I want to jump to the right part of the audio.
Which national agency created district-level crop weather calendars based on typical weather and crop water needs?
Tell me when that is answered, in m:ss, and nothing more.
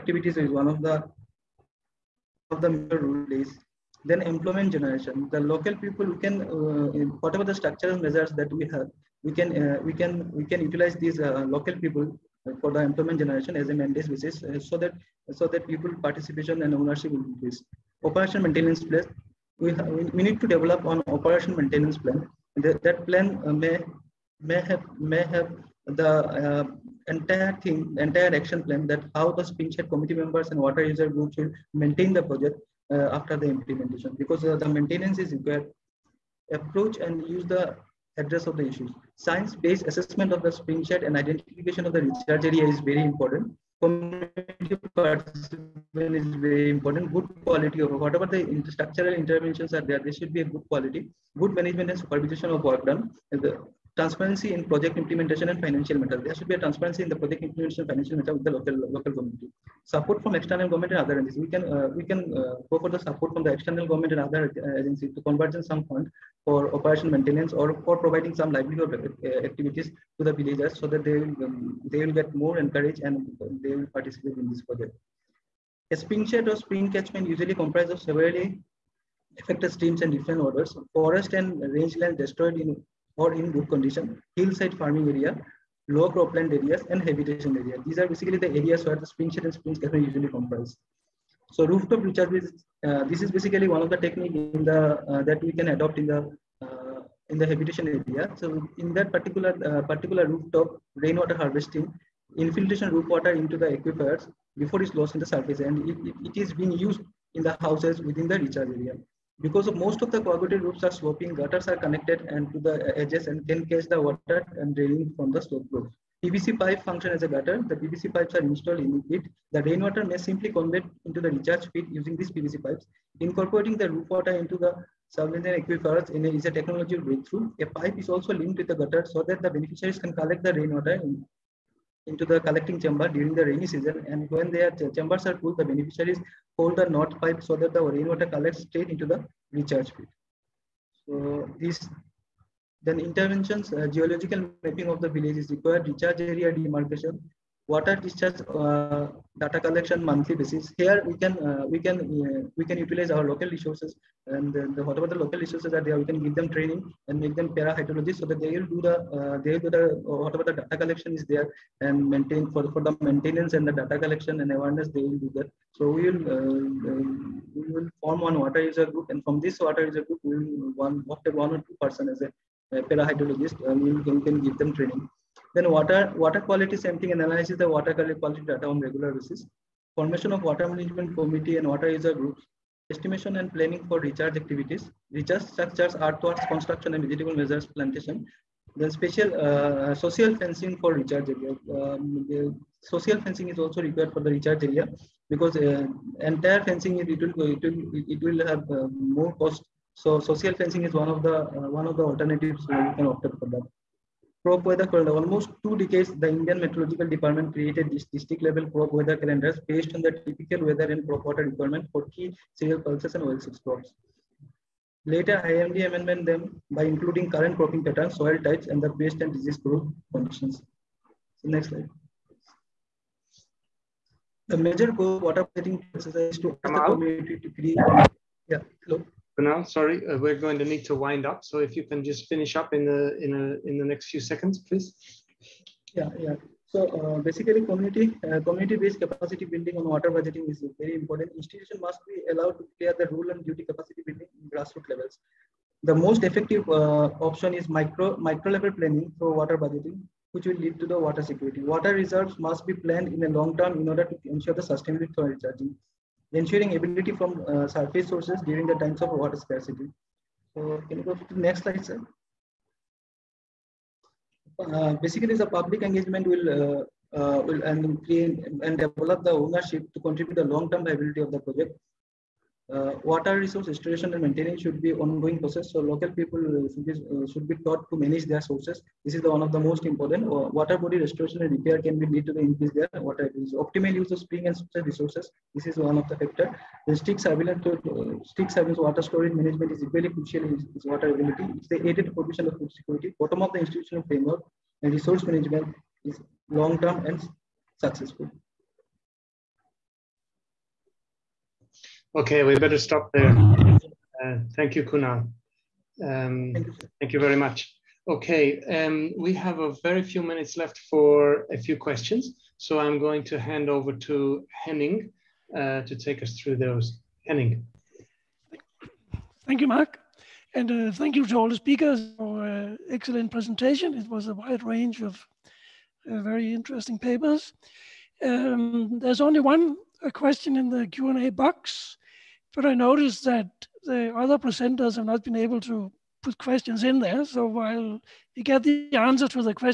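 3:26.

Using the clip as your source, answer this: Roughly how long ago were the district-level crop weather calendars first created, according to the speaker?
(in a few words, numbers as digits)
Almost two decades.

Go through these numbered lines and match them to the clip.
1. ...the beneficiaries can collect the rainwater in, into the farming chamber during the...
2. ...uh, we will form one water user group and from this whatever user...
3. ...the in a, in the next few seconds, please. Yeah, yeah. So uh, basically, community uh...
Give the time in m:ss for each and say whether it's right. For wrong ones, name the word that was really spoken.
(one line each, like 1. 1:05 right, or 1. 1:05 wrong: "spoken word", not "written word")
1. 2:09 wrong: "collecting", not "farming"
2. 2:46 wrong: "water", not "whatever"
3. 3:52 right.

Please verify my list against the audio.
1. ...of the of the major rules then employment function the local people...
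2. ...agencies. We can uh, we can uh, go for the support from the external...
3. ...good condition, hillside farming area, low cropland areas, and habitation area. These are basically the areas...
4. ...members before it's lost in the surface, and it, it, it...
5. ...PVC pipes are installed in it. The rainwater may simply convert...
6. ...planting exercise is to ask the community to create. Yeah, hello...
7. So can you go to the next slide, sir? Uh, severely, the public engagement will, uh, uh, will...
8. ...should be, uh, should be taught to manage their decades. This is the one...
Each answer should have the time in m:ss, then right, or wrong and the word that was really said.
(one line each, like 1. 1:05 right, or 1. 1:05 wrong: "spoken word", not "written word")
1. 0:00 wrong: "generation", not "function"
2. 1:01 right
3. 1:23 right
4. 1:43 wrong: "aquifers", not "members"
5. 1:57 right
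6. 3:45 right
7. 4:20 wrong: "basically", not "severely"
8. 4:36 wrong: "sources", not "decades".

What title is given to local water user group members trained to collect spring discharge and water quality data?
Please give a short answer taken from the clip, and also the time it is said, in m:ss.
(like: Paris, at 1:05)
Para hydrologists, at 2:37.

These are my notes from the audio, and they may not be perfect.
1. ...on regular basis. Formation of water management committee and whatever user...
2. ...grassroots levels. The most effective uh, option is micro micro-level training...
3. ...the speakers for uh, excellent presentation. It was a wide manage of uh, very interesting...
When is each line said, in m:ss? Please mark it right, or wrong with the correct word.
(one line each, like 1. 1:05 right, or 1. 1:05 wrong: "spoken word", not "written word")
1. 2:58 wrong: "water", not "whatever"
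2. 4:04 wrong: "planning", not "training"
3. 5:21 wrong: "range", not "manage".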